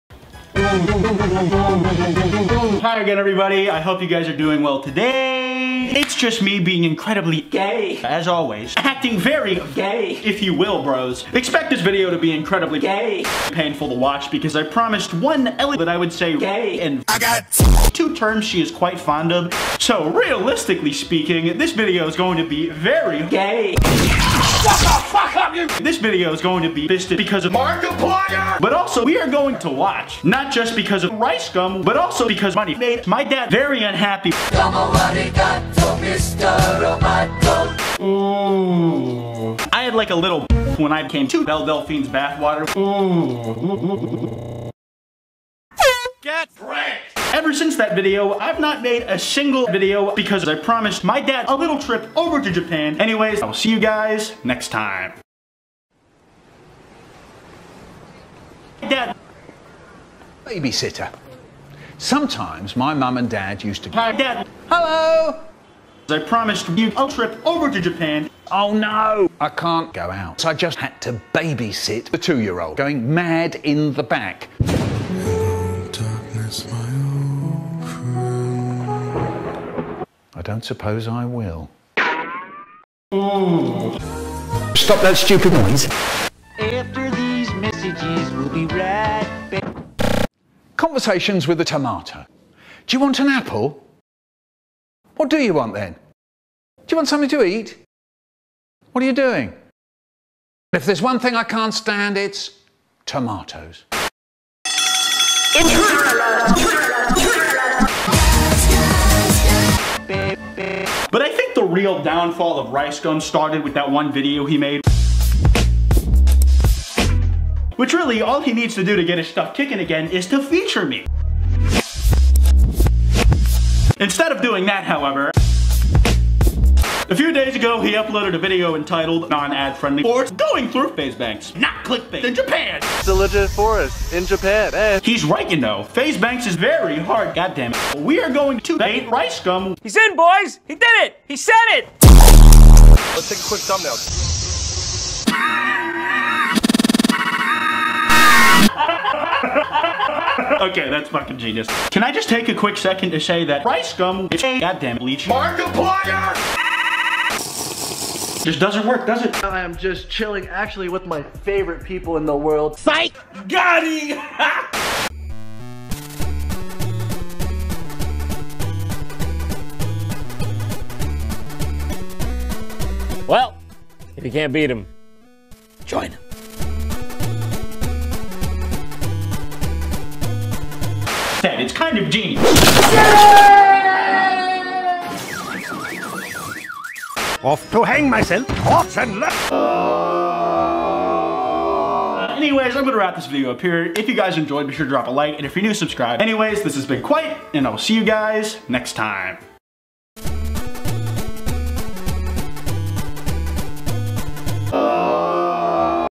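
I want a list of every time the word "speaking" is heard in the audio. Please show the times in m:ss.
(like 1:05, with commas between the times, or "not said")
0:20.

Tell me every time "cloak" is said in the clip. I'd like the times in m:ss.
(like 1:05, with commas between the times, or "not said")
not said.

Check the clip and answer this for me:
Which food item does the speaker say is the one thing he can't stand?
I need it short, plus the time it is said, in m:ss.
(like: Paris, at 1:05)
Tomatoes, at 1:43.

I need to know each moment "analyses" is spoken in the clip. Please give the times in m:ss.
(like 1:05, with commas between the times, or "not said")
not said.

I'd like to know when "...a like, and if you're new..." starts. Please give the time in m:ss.
3:15.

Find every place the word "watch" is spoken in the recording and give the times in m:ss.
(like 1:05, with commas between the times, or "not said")
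0:13, 0:29.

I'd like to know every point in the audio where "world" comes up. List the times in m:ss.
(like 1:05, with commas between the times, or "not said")
2:42.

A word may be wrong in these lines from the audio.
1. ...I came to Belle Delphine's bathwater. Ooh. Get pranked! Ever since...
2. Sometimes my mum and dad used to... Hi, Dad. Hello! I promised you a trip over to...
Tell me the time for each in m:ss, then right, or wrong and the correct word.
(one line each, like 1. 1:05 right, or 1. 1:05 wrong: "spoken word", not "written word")
1. 0:40 right
2. 1:01 right.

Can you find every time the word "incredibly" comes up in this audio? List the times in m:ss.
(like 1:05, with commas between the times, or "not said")
0:06, 0:12.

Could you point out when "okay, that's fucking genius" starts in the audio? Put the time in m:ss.
2:30.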